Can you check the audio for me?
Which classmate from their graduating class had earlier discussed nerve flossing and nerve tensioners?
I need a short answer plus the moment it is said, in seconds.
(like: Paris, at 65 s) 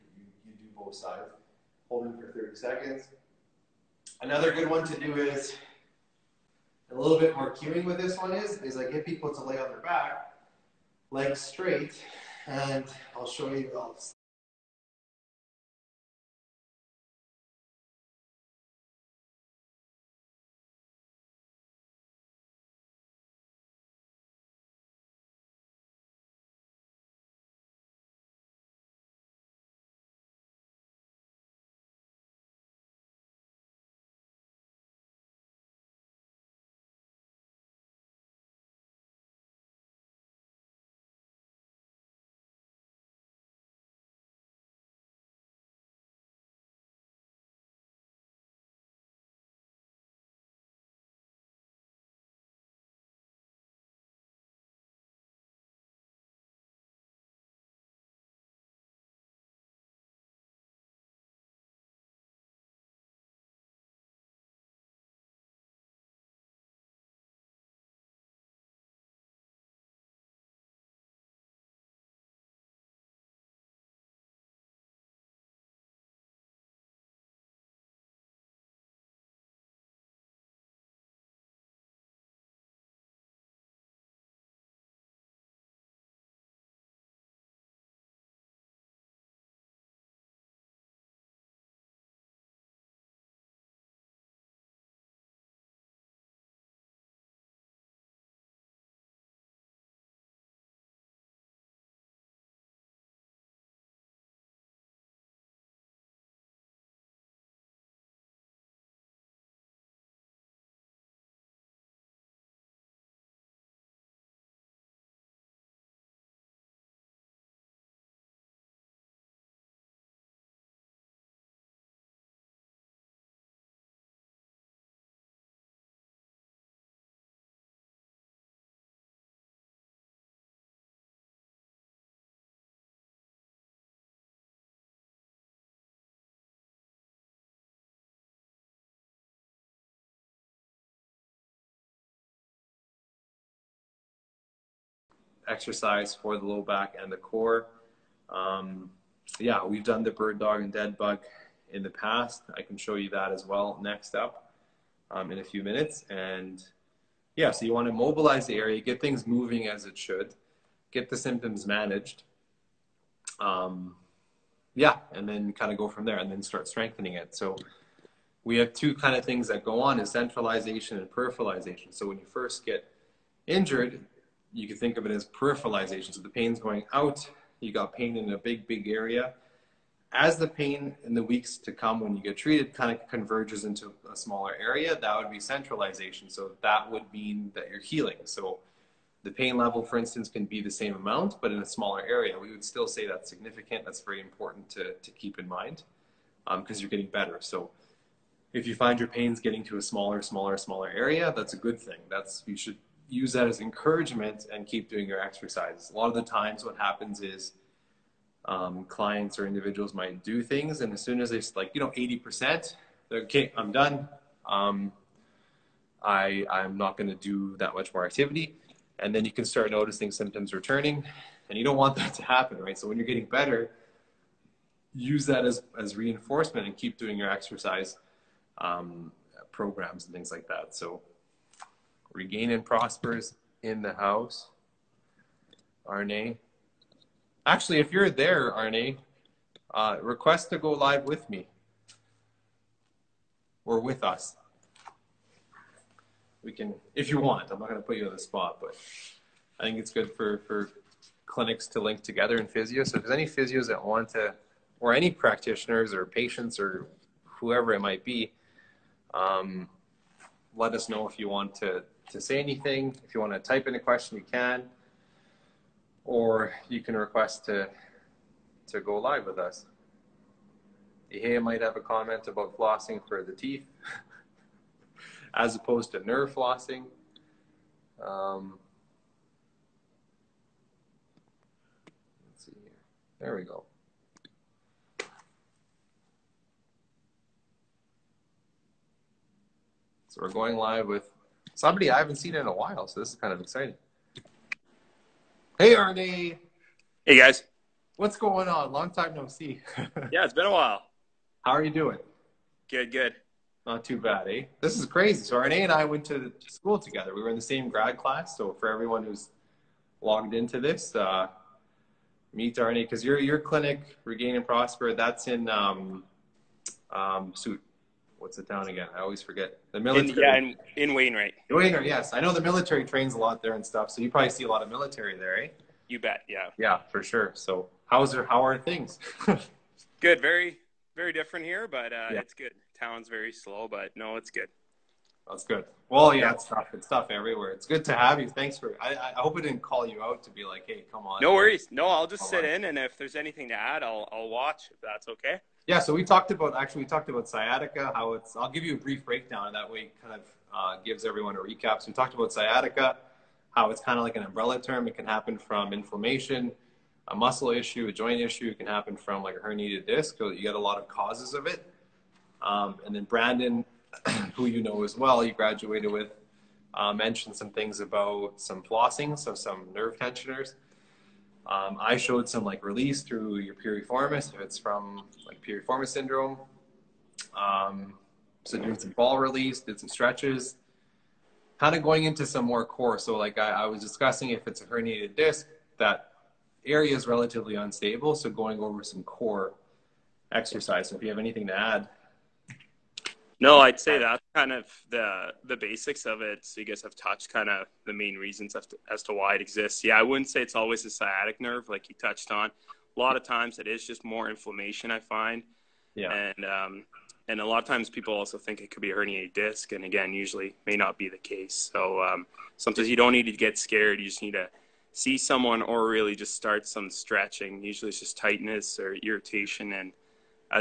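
Brandon, at 363 s.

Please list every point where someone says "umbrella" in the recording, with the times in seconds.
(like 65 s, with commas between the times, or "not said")
354 s.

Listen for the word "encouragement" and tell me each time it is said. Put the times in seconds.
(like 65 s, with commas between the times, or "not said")
203 s.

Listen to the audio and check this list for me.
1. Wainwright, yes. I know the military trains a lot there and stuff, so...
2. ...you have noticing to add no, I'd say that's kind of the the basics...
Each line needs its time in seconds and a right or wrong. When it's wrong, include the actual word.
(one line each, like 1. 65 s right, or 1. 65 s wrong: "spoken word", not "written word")
1. 321 s right
2. 391 s wrong: "anything", not "noticing".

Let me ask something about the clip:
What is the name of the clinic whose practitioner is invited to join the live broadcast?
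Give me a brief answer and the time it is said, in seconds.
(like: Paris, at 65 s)
Regain and Prosper, at 314 s.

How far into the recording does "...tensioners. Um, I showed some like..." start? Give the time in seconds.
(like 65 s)
369 s.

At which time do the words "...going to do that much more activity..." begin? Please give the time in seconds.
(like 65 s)
216 s.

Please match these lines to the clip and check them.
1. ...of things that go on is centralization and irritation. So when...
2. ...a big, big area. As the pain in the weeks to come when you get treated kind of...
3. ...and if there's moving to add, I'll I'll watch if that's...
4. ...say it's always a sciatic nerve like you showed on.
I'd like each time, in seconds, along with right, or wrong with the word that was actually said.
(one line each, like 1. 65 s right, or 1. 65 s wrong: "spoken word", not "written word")
1. 169 s wrong: "peripheralization", not "irritation"
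2. 178 s right
3. 342 s wrong: "anything", not "moving"
4. 400 s wrong: "touched", not "showed".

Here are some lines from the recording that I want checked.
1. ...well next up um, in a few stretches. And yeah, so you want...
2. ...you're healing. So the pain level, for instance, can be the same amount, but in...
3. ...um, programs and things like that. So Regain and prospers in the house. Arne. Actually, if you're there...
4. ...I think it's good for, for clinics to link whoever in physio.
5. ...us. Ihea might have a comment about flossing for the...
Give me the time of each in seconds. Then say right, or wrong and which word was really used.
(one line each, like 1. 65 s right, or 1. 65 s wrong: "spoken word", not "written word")
1. 153 s wrong: "minutes", not "stretches"
2. 187 s right
3. 228 s right
4. 249 s wrong: "together", not "whoever"
5. 269 s right.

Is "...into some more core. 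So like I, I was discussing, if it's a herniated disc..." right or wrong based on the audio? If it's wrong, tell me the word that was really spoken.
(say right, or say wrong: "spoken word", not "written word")
right.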